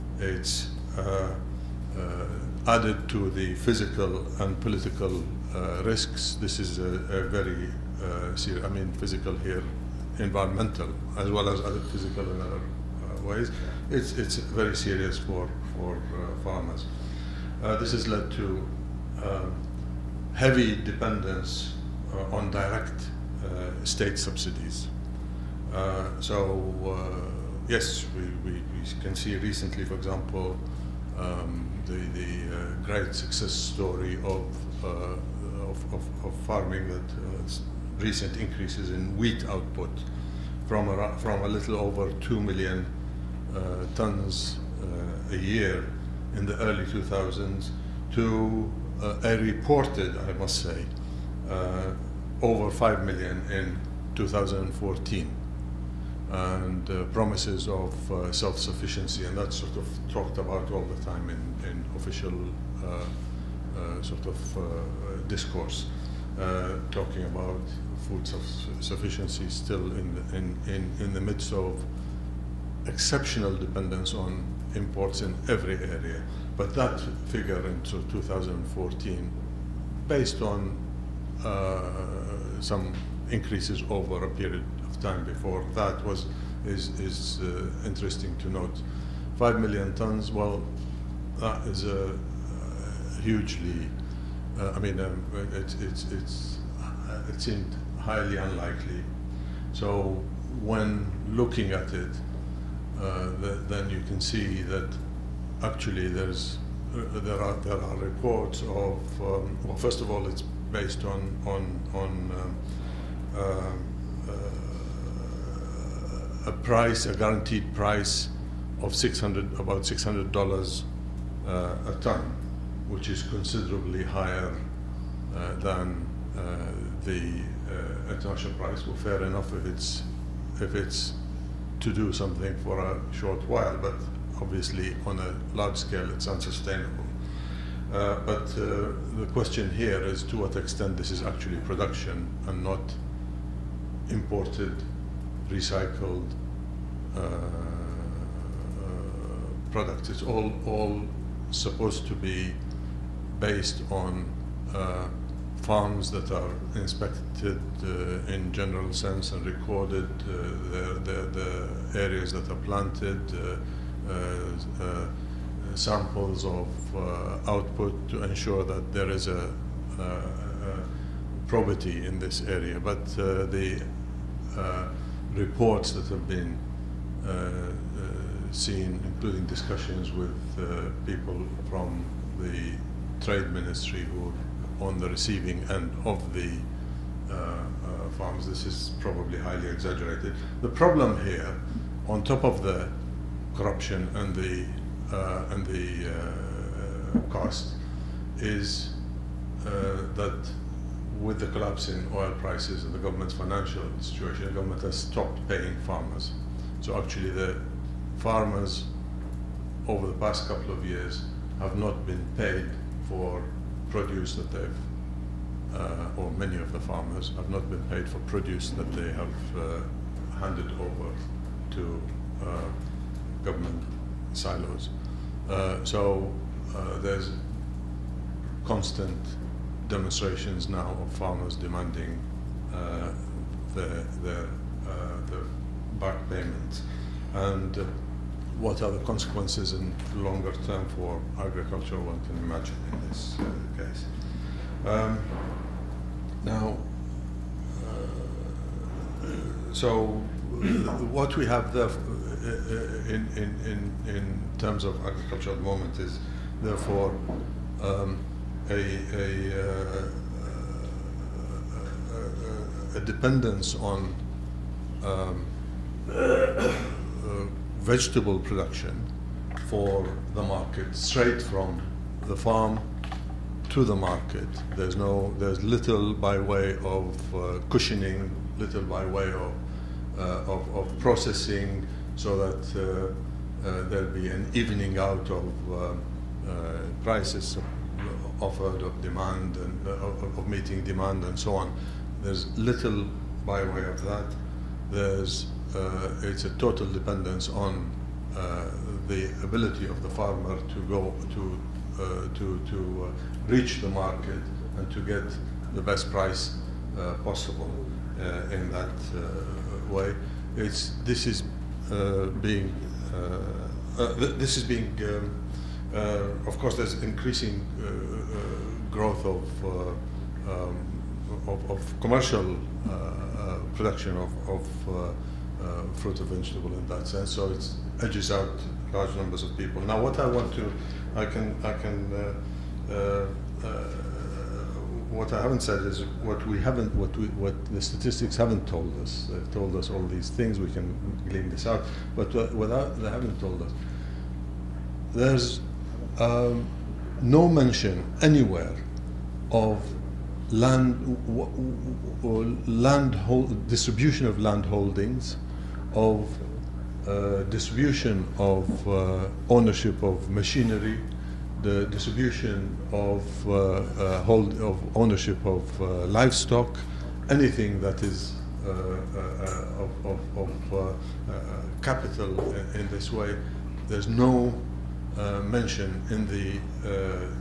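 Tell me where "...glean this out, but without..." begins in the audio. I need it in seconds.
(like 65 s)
341 s.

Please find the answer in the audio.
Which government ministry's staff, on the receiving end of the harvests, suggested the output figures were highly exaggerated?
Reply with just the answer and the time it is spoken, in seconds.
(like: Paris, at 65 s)
trade ministry, at 183 s.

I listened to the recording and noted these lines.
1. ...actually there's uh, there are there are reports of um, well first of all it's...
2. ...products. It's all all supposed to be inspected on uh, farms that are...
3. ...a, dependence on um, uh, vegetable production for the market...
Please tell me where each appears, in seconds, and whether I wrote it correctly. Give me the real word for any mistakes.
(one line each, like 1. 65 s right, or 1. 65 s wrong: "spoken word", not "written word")
1. 105 s right
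2. 149 s wrong: "based", not "inspected"
3. 262 s right.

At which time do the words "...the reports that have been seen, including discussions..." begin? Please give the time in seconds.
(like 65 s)
173 s.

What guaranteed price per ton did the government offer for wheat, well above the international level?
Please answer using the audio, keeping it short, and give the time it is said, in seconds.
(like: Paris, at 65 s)
about $600, at 119 s.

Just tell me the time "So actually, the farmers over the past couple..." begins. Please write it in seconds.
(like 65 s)
206 s.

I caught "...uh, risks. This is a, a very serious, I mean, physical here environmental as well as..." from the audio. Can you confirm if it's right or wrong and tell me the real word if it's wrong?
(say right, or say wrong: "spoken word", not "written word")
right.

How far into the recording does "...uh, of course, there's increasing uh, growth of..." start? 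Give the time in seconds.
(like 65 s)
315 s.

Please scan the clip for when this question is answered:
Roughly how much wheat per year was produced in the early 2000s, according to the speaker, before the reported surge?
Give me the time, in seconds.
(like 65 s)
41 s.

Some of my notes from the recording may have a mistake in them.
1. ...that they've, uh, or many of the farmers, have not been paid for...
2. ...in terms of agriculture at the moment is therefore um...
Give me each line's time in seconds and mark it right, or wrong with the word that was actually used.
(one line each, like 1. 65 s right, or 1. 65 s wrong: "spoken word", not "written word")
1. 214 s right
2. 254 s right.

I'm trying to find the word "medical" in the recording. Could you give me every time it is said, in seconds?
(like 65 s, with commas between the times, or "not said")
not said.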